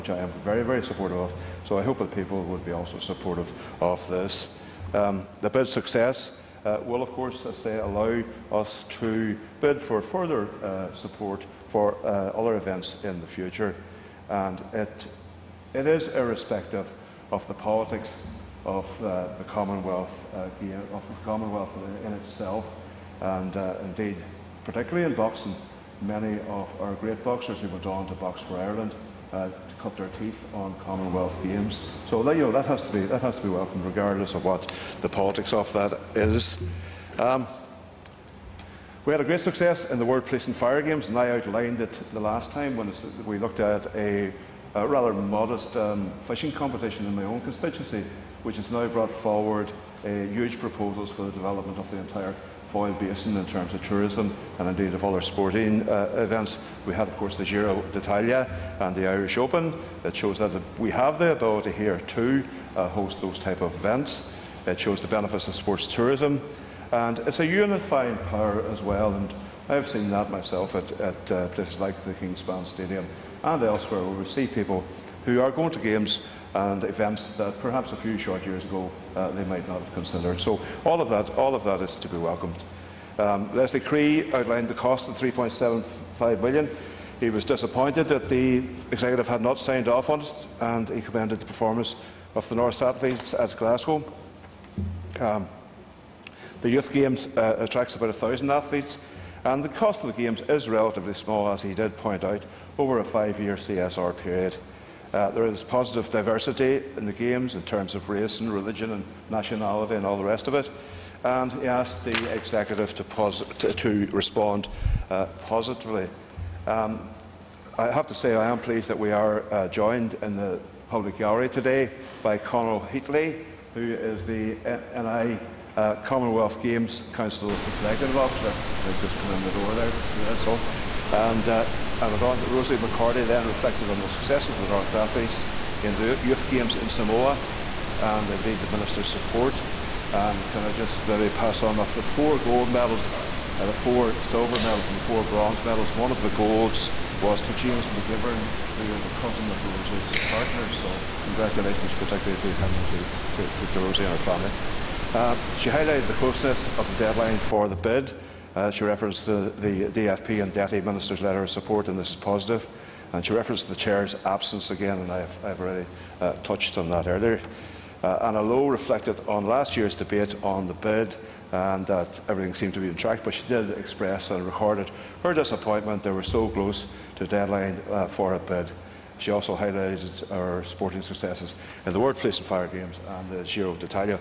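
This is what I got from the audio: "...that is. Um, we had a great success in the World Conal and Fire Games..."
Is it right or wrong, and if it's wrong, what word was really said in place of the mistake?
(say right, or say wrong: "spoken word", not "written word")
wrong: "Police", not "Conal".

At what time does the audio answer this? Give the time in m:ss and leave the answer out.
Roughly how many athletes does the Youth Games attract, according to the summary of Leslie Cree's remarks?
1:38.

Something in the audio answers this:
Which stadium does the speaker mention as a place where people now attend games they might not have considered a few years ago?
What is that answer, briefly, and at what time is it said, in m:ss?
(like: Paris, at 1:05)
Kingspan Stadium, at 1:12.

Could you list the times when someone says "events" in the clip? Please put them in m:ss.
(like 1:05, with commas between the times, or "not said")
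0:12, 0:56, 1:03, 1:16.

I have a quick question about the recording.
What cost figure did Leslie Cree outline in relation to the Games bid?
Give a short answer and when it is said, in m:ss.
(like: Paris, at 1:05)
3.75 billion, at 1:25.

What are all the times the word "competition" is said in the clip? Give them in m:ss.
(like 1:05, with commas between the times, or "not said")
0:46.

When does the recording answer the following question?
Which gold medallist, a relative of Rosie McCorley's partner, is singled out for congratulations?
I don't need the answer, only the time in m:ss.
2:27.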